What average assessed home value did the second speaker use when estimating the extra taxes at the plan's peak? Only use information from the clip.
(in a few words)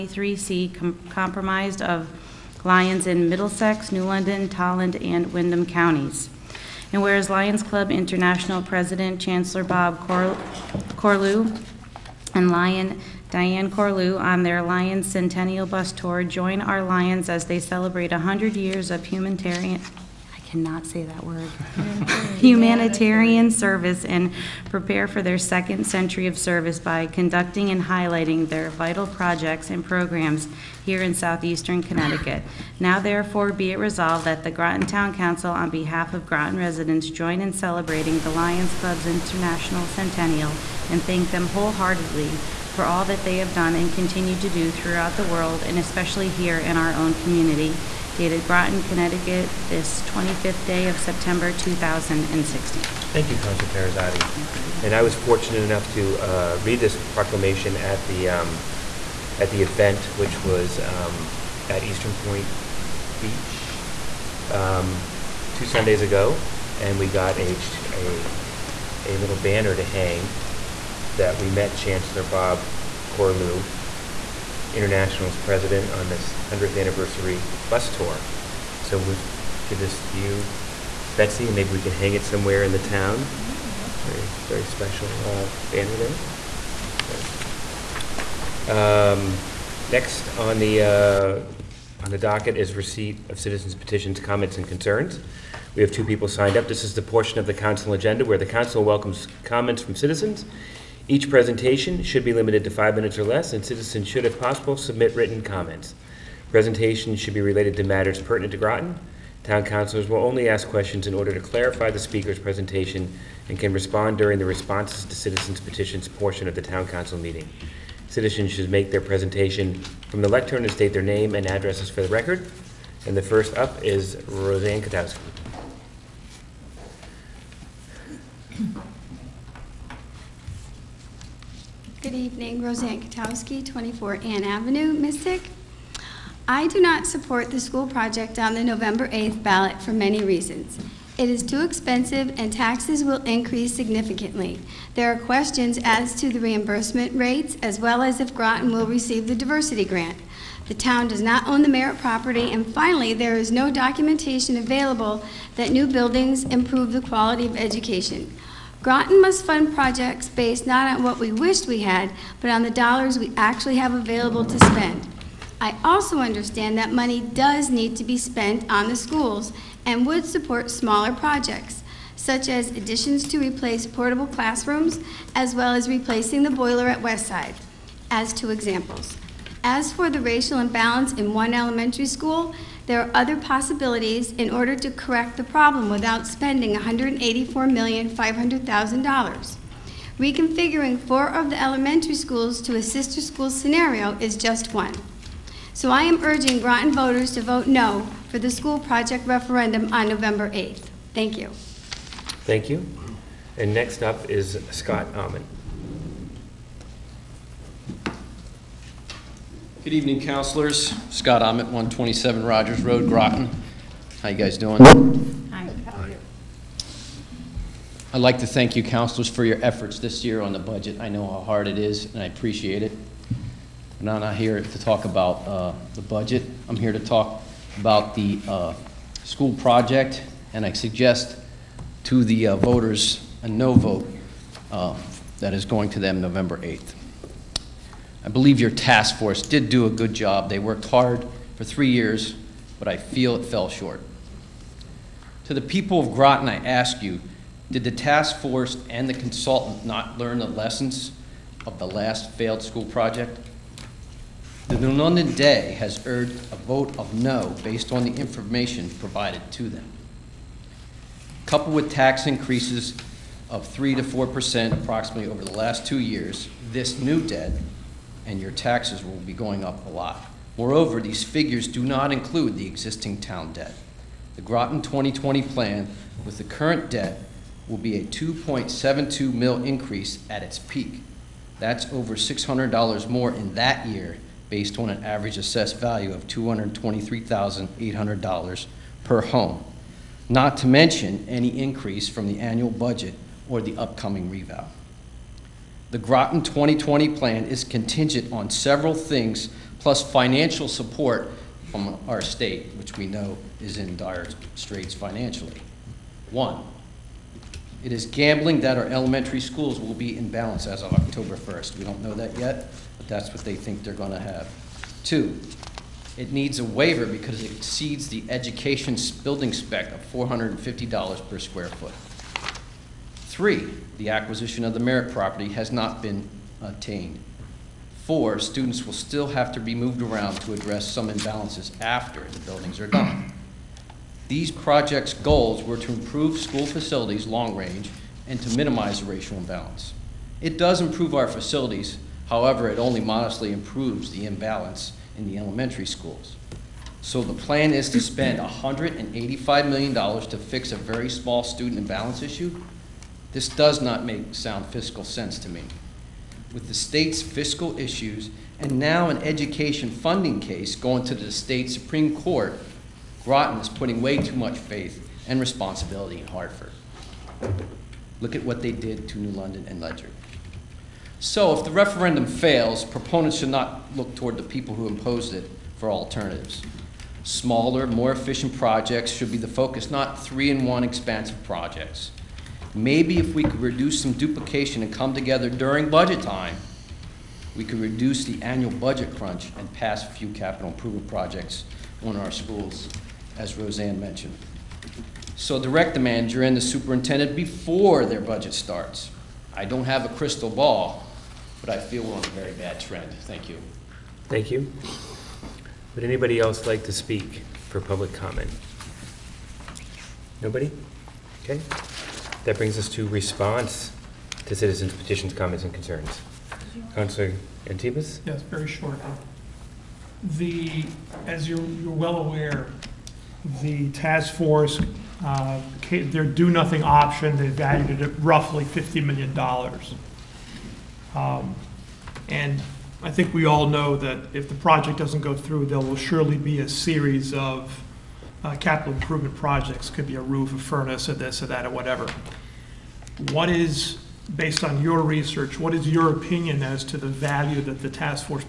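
$223,800.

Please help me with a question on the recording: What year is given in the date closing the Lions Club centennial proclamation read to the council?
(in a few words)
2016.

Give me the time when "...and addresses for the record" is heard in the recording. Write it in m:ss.
2:01.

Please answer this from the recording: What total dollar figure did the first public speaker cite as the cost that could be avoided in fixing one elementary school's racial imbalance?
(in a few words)
$184,500,000.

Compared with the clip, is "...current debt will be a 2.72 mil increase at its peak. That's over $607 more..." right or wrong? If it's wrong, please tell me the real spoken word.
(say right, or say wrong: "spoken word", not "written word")
wrong: "600", not "607".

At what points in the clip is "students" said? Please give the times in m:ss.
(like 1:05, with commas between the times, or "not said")
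5:28, 5:51.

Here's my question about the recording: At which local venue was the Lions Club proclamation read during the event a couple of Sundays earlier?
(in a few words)
Eastern Point Beach.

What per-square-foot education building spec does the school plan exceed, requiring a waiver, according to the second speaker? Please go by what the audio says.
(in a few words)
$450.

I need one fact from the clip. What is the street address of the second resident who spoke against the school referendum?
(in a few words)
127 Rogers Road.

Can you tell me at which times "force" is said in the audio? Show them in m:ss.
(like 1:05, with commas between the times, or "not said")
3:59, 4:08, 7:04.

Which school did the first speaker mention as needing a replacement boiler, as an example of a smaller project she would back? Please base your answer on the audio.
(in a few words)
Westside.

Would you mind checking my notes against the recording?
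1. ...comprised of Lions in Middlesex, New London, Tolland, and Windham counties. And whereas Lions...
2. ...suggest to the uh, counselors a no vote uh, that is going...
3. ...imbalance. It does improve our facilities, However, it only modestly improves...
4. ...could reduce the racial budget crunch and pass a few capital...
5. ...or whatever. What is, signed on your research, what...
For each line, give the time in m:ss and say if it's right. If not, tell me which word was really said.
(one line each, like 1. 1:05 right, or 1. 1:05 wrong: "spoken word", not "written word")
1. 0:01 right
2. 3:50 wrong: "voters", not "counselors"
3. 5:39 right
4. 6:27 wrong: "annual", not "racial"
5. 7:21 wrong: "based", not "signed".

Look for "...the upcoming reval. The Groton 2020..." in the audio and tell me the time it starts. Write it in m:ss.
4:53.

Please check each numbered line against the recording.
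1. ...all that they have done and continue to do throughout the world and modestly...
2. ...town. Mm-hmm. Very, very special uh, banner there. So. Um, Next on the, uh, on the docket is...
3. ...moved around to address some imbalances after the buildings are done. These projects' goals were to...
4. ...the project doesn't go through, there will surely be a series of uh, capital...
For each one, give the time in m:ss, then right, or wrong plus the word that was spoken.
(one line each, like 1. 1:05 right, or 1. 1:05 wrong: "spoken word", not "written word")
1. 0:42 wrong: "especially", not "modestly"
2. 1:22 right
3. 5:29 right
4. 7:14 right.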